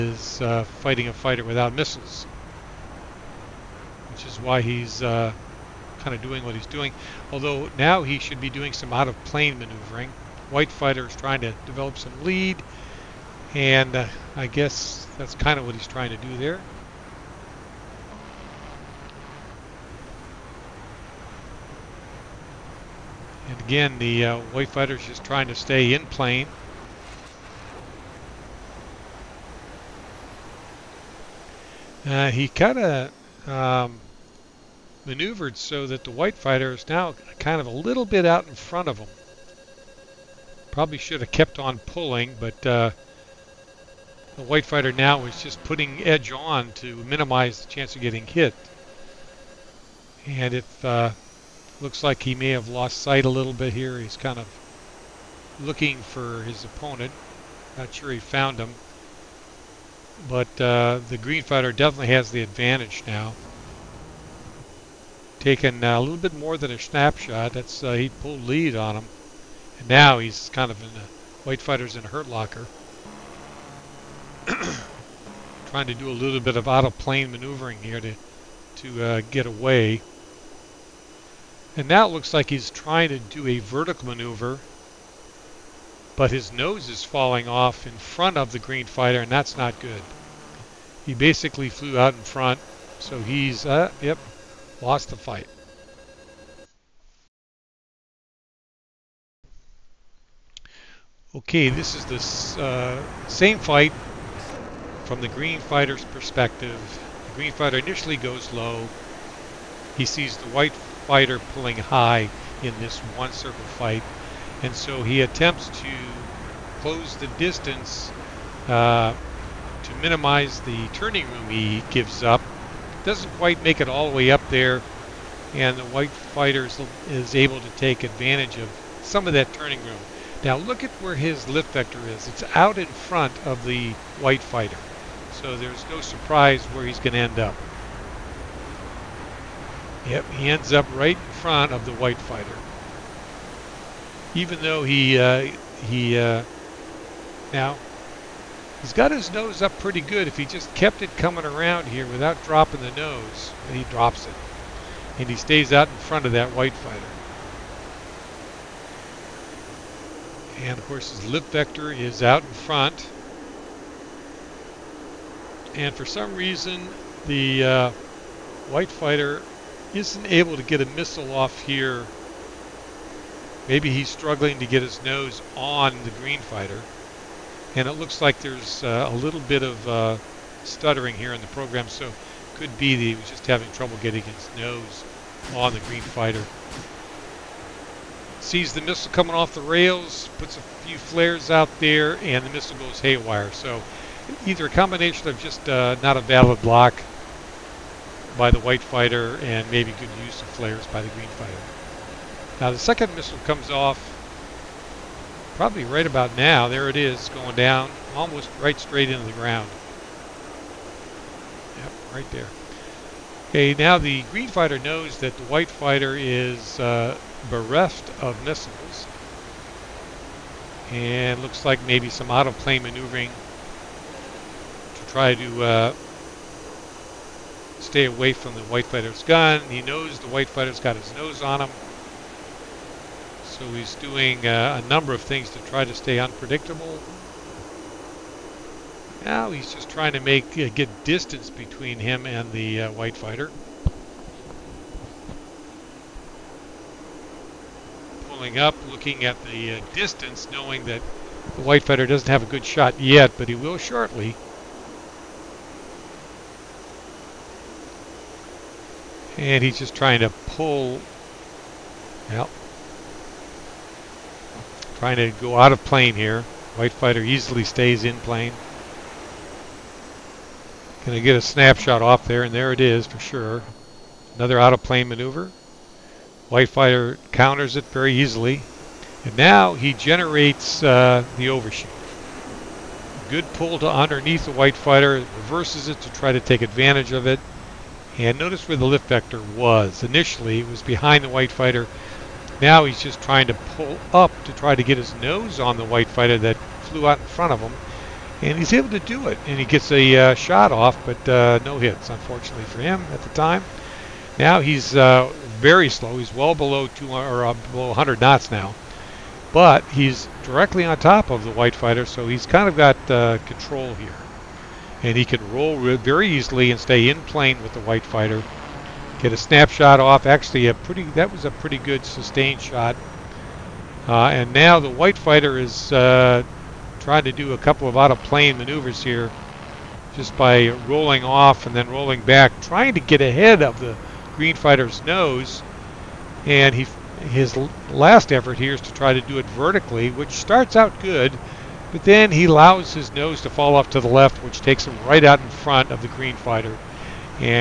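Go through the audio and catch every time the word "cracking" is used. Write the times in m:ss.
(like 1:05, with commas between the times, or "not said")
not said.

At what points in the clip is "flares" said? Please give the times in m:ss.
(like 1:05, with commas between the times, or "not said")
3:10, 3:20.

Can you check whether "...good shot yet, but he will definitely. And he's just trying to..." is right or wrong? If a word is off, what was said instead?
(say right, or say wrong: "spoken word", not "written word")
wrong: "shortly", not "definitely".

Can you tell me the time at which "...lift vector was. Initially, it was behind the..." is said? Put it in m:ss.
4:48.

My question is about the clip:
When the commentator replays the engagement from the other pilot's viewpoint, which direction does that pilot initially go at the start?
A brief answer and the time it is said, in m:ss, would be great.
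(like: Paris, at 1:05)
Low, at 1:47.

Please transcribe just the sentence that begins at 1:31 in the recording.
He basically flew out in front, so he's, uh, yep, lost the fight.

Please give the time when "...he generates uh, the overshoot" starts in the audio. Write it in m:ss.
4:39.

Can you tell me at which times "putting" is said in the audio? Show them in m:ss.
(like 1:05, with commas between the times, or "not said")
0:45.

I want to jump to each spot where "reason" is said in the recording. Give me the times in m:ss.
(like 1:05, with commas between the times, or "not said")
2:46.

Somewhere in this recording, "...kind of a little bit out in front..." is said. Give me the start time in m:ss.
0:37.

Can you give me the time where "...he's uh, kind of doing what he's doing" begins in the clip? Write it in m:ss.
0:04.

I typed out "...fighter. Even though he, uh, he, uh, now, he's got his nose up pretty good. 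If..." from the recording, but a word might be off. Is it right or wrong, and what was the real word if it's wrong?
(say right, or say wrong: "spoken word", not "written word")
right.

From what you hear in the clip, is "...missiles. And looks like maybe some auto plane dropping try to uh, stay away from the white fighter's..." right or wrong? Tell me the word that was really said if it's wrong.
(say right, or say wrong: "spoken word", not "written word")
wrong: "maneuvering", not "dropping".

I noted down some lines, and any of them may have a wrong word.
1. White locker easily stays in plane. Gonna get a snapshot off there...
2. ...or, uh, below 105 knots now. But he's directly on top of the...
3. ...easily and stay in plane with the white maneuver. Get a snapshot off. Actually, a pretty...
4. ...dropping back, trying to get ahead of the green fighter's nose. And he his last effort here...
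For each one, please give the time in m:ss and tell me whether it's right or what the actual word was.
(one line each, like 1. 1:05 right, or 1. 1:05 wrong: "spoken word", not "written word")
1. 4:26 wrong: "fighter", not "locker"
2. 5:07 wrong: "100", not "105"
3. 5:16 wrong: "fighter", not "maneuver"
4. 5:31 wrong: "rolling", not "dropping".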